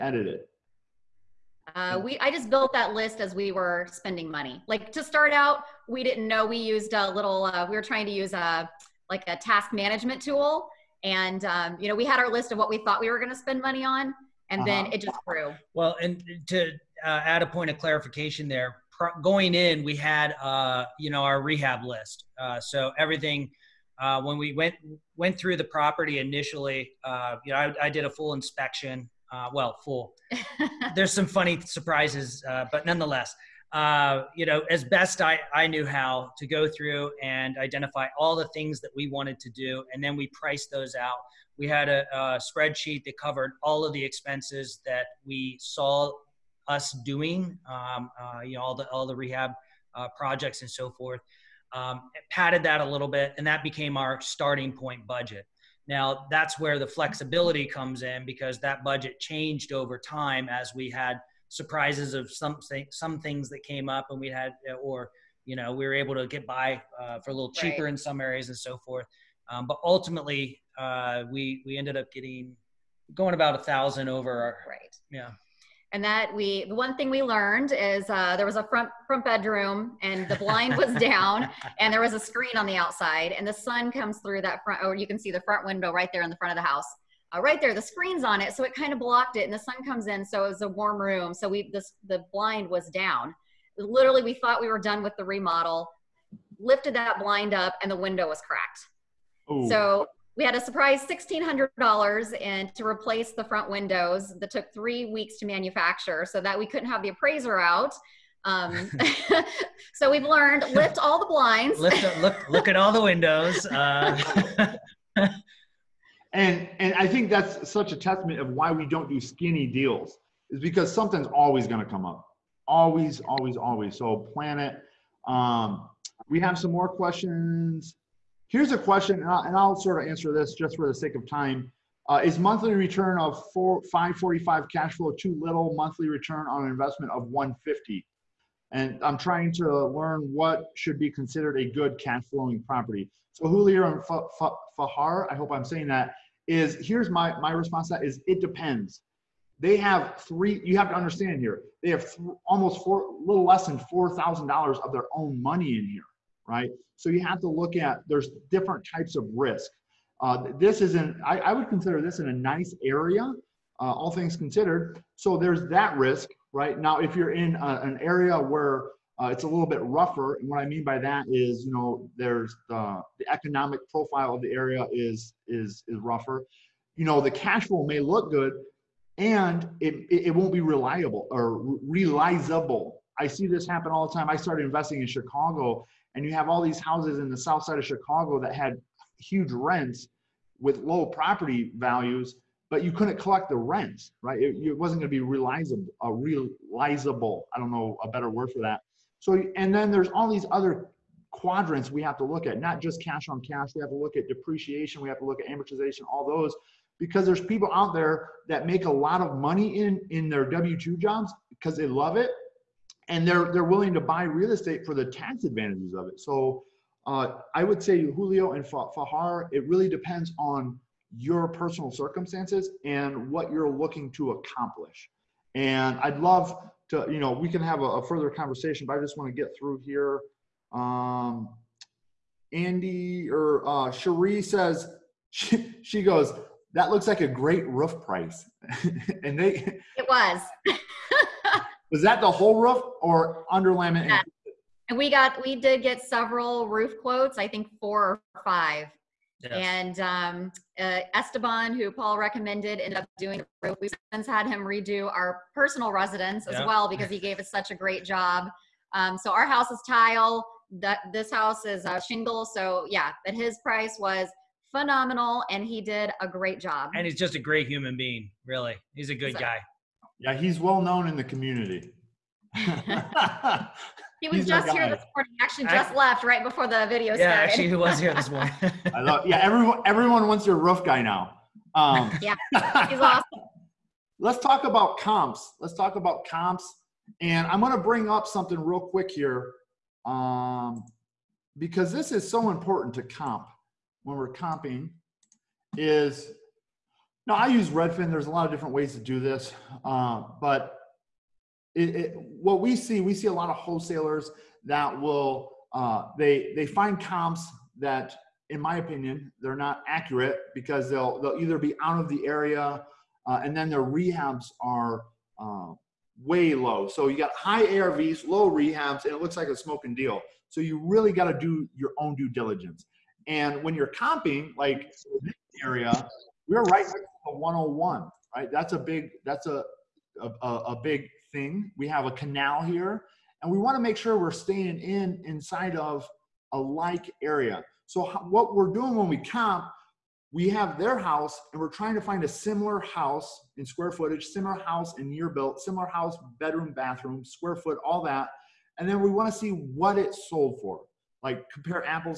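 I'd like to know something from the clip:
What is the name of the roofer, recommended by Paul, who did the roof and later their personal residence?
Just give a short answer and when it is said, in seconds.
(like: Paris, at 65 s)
Esteban, at 251 s.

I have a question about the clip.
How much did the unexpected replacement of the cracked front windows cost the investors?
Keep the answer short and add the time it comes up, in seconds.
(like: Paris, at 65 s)
$1,600, at 101 s.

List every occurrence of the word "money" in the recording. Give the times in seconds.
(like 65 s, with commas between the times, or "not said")
4 s, 13 s, 155 s, 209 s.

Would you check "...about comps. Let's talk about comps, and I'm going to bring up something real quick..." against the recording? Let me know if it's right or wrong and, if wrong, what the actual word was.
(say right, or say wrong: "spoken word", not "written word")
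right.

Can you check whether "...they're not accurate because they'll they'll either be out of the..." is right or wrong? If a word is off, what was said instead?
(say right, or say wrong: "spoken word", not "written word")
right.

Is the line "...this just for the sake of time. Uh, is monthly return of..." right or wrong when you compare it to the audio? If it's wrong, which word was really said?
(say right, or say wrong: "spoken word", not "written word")
right.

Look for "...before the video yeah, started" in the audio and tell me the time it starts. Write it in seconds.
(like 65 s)
276 s.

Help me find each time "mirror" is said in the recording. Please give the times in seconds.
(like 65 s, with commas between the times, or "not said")
not said.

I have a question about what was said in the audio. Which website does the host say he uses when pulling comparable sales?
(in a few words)
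Redfin.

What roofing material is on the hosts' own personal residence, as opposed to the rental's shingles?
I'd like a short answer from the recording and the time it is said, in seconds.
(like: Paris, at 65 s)
tile, at 259 s.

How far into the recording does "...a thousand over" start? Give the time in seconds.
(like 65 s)
73 s.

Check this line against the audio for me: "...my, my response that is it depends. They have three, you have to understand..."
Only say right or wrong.
right.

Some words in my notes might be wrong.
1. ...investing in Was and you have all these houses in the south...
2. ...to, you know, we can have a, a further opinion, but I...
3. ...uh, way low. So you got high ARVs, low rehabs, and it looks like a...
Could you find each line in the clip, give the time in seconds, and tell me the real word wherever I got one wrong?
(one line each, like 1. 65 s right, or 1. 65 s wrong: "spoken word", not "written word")
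1. 184 s wrong: "Chicago", not "Was"
2. 226 s wrong: "conversation", not "opinion"
3. 315 s right.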